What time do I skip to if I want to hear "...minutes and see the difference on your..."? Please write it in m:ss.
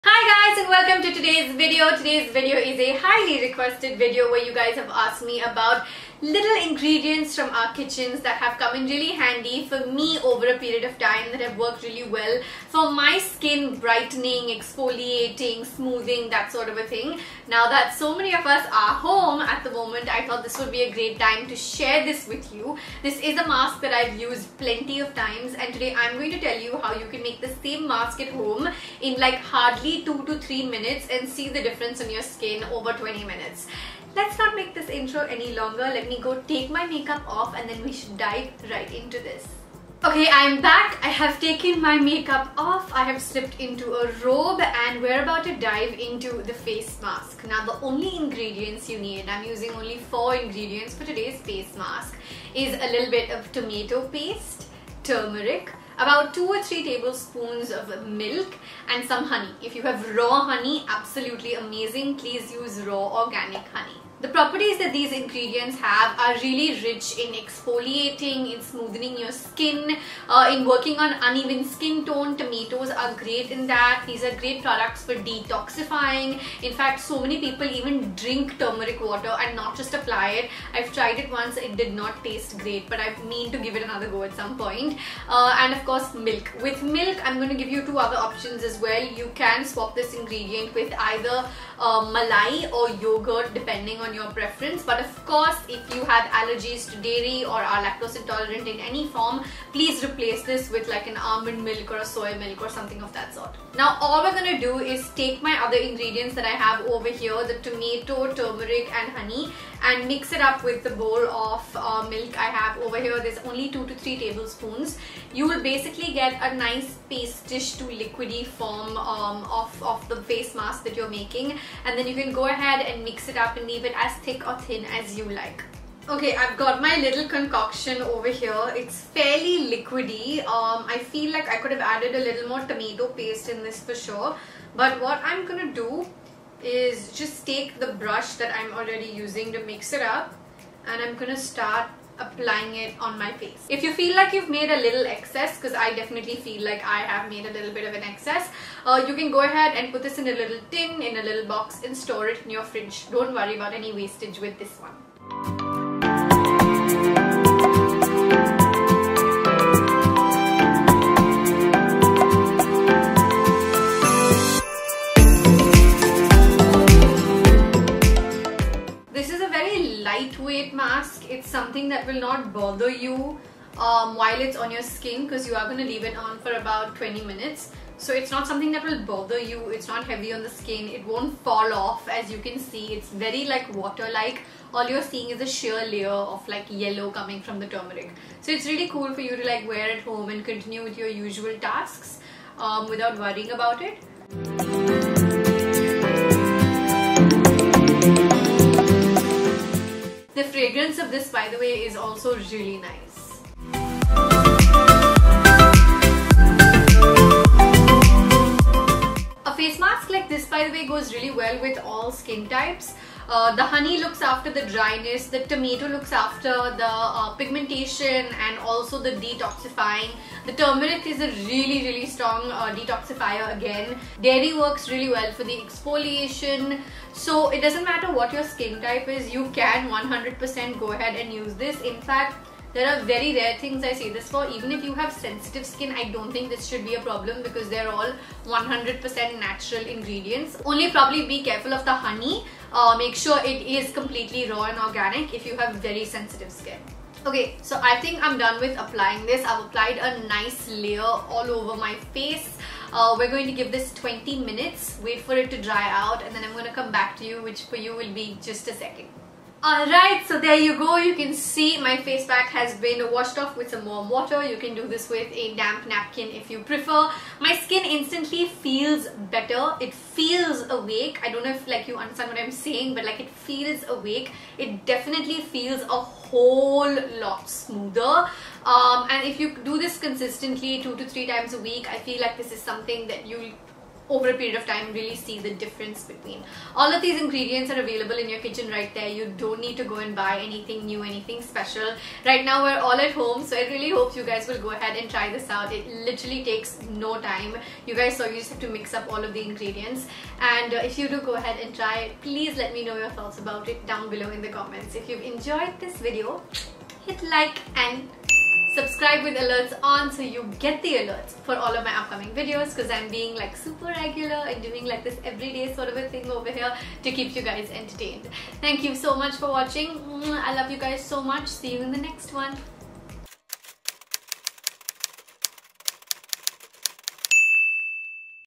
0:30.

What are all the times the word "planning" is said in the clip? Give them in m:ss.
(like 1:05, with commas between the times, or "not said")
not said.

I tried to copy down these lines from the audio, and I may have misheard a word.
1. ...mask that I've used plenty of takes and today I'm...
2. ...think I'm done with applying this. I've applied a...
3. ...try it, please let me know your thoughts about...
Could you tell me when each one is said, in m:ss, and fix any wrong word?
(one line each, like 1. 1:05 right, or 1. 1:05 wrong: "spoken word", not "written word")
1. 0:23 wrong: "times", not "takes"
2. 4:07 right
3. 5:01 right.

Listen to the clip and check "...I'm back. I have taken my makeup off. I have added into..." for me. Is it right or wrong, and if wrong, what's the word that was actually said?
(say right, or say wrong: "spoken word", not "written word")
wrong: "slipped", not "added".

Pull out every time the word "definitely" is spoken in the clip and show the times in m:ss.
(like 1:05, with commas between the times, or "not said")
2:25, 4:34.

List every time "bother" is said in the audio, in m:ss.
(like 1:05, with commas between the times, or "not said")
2:52, 2:59.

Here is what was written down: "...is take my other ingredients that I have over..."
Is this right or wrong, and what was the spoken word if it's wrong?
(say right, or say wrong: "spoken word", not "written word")
right.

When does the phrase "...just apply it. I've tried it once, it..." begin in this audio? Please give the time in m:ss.
1:19.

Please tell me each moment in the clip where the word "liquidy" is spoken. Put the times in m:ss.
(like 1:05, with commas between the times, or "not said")
1:57, 2:09.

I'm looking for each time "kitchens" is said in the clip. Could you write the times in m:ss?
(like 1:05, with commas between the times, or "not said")
0:07, 4:48.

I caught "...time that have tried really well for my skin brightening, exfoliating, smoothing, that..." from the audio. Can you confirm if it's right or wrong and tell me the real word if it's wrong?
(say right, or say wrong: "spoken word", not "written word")
wrong: "worked", not "tried".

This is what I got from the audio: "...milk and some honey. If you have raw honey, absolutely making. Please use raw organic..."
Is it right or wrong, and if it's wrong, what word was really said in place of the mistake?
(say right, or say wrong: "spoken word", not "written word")
wrong: "amazing", not "making".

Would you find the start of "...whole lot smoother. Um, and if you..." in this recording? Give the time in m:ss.
4:36.